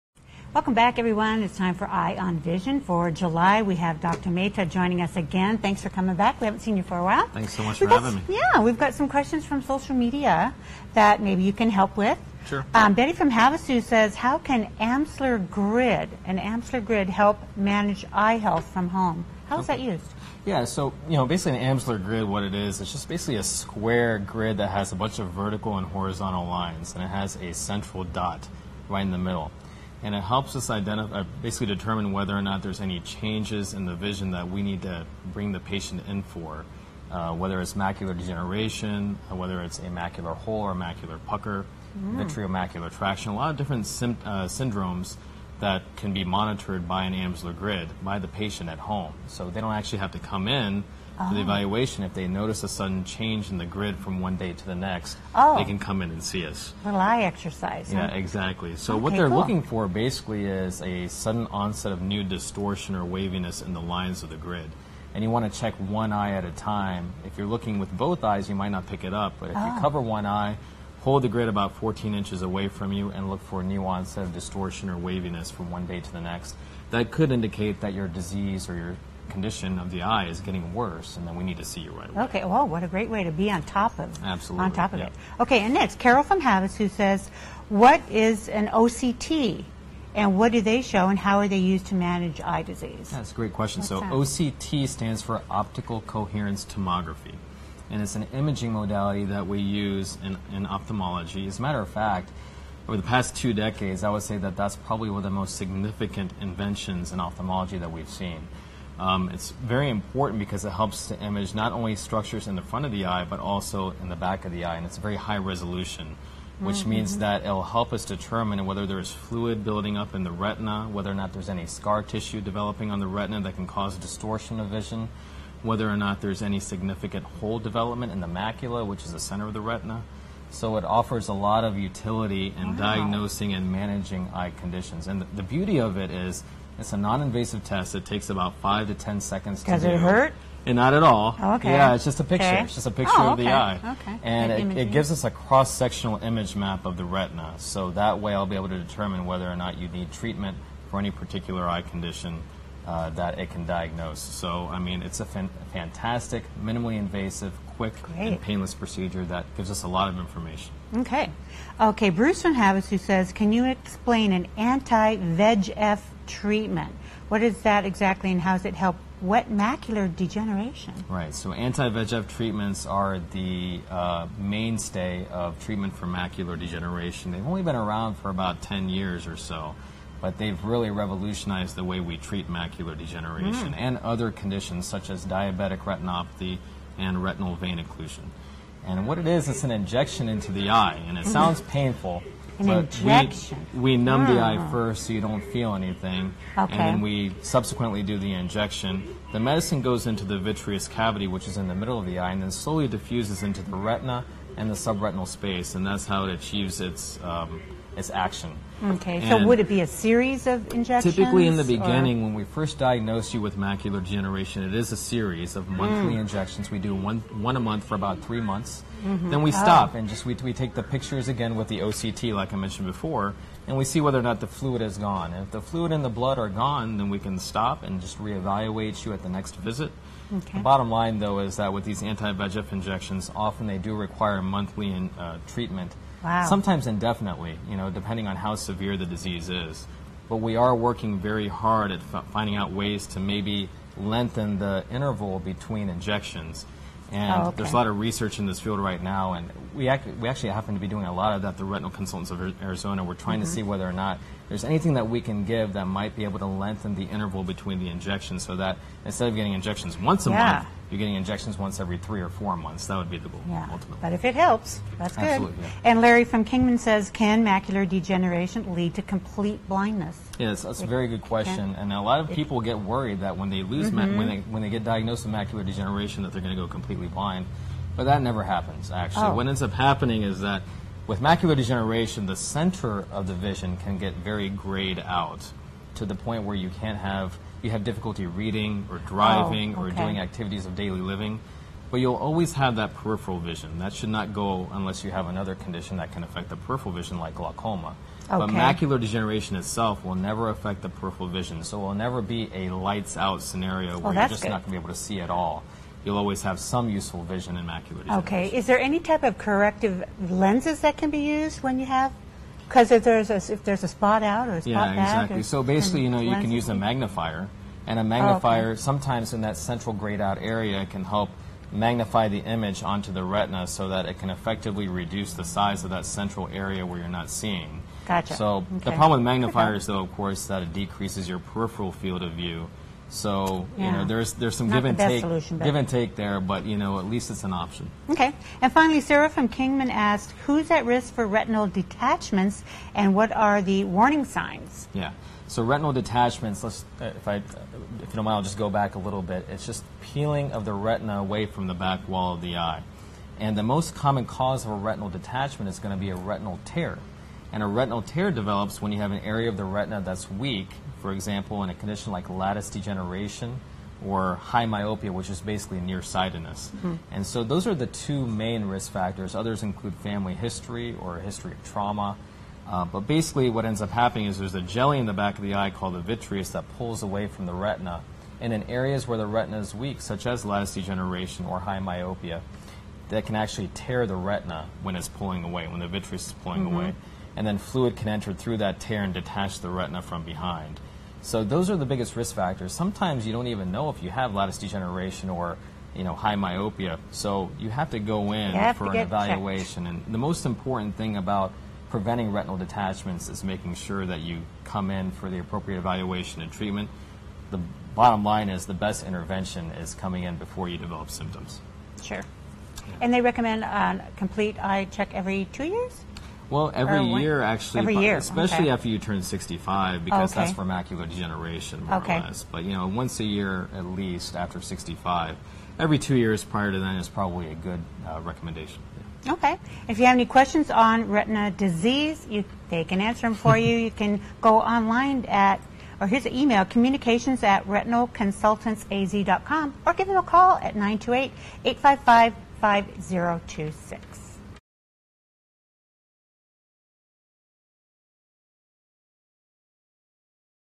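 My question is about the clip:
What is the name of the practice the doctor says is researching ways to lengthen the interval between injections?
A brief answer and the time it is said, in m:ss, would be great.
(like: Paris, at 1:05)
Retinal Consultants of Arizona, at 4:11.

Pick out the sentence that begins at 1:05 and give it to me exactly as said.
And you want to check one eye at a time.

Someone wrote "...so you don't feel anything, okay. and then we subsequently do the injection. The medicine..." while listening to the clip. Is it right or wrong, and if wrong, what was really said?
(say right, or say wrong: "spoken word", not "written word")
right.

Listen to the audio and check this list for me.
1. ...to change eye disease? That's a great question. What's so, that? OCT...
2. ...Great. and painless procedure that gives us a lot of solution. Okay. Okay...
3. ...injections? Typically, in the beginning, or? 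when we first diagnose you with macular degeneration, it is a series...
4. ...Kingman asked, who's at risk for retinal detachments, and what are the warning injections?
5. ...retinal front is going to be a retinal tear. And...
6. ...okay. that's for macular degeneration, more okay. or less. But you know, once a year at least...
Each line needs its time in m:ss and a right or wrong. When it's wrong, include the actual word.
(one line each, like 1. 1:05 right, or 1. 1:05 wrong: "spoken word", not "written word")
1. 1:31 wrong: "manage", not "change"
2. 2:38 wrong: "information", not "solution"
3. 3:30 right
4. 5:39 wrong: "signs", not "injections"
5. 5:54 wrong: "detachment", not "front"
6. 7:00 right.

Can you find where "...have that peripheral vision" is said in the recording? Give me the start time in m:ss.
4:52.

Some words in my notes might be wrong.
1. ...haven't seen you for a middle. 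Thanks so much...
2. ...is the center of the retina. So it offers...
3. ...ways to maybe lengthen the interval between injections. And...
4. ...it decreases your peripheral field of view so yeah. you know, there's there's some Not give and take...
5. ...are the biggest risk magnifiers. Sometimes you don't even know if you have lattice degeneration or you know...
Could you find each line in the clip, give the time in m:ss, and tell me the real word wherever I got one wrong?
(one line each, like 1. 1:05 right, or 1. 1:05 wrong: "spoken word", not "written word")
1. 0:06 wrong: "while", not "middle"
2. 2:09 right
3. 4:02 right
4. 5:30 right
5. 6:31 wrong: "factors", not "magnifiers".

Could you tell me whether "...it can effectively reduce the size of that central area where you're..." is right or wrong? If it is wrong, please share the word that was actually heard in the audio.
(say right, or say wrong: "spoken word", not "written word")
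right.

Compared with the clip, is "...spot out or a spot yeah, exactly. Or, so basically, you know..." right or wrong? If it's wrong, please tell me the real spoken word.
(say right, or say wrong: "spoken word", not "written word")
right.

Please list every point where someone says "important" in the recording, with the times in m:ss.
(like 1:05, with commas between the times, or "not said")
1:49, 6:40.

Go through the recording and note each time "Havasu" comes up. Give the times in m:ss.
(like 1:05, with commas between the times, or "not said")
0:13, 1:26, 2:42.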